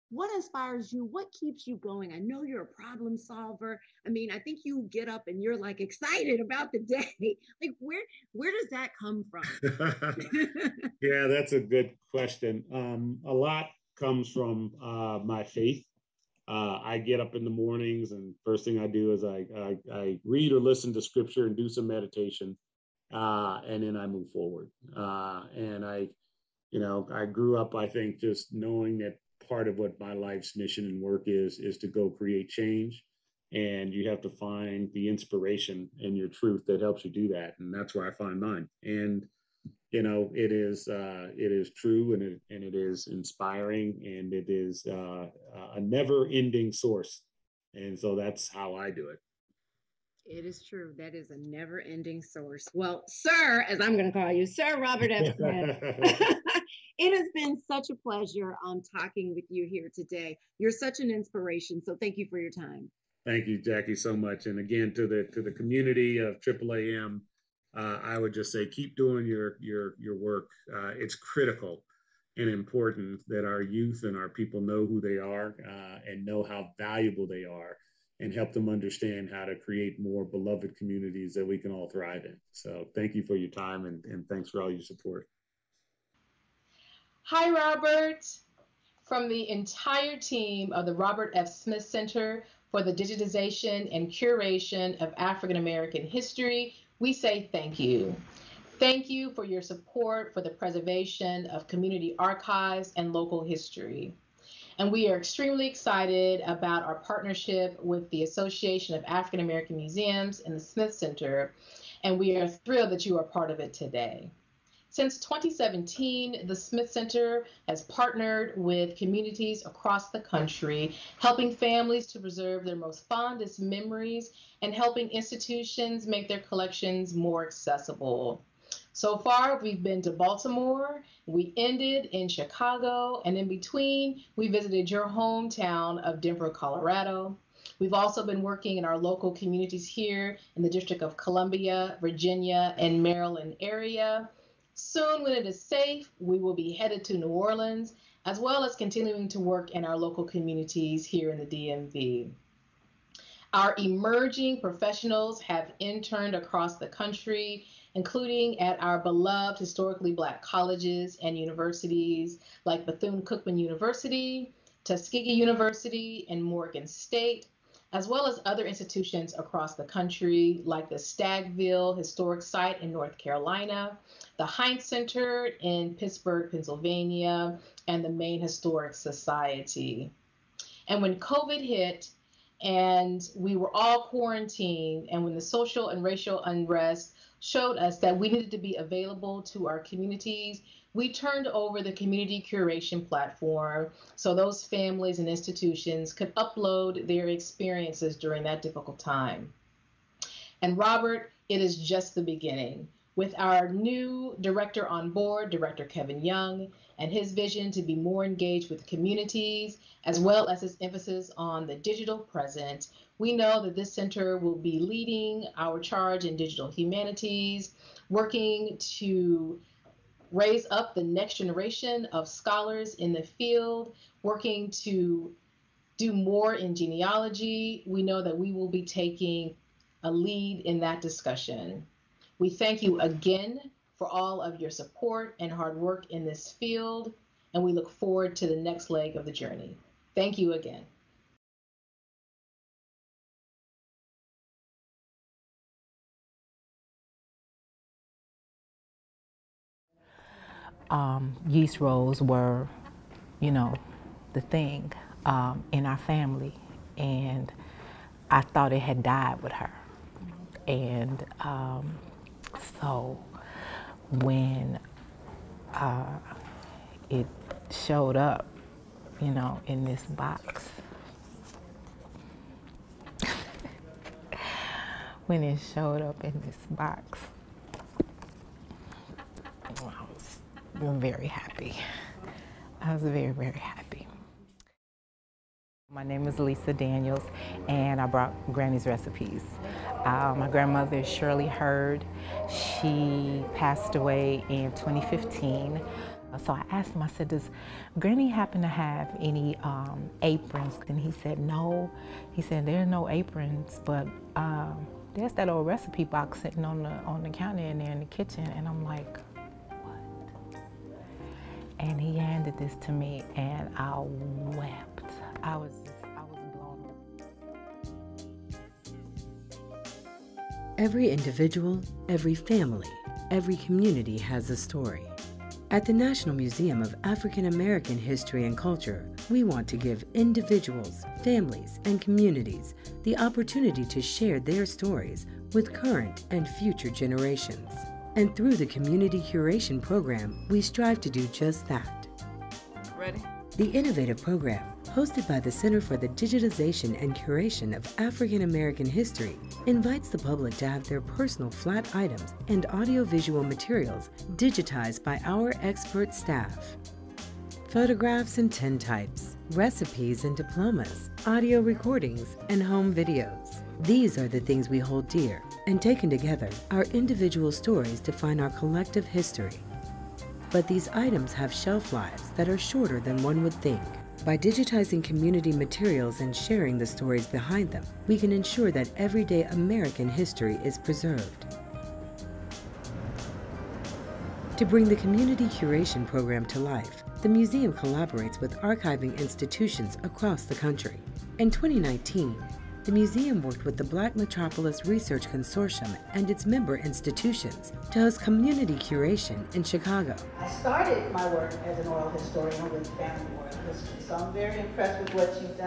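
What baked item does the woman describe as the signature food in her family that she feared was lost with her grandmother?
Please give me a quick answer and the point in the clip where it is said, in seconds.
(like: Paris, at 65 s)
Yeast rolls, at 251 s.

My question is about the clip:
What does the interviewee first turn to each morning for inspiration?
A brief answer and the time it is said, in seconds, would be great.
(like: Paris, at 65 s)
Scripture, at 21 s.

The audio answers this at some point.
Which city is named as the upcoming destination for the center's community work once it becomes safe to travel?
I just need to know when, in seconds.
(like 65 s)
147 s.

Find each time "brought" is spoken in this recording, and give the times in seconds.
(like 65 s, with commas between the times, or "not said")
288 s.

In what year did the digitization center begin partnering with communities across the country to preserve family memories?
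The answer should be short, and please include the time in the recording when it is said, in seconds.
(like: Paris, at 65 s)
2017, at 115 s.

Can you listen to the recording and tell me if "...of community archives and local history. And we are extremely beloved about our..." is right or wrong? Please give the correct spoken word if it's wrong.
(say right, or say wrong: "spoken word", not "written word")
wrong: "excited", not "beloved".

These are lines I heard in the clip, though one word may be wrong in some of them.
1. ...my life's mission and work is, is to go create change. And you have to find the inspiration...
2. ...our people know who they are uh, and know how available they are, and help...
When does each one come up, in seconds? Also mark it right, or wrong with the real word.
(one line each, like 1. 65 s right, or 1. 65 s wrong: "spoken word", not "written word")
1. 29 s right
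2. 74 s wrong: "valuable", not "available".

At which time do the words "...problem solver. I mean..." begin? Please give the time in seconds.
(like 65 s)
2 s.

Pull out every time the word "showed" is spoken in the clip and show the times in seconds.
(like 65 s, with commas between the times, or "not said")
187 s, 267 s, 275 s.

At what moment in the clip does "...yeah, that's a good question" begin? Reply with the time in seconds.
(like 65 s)
11 s.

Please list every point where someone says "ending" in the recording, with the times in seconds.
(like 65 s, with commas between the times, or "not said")
46 s, 51 s.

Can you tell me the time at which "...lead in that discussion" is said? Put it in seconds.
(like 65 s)
230 s.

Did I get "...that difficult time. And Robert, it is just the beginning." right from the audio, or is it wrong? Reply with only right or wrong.
right.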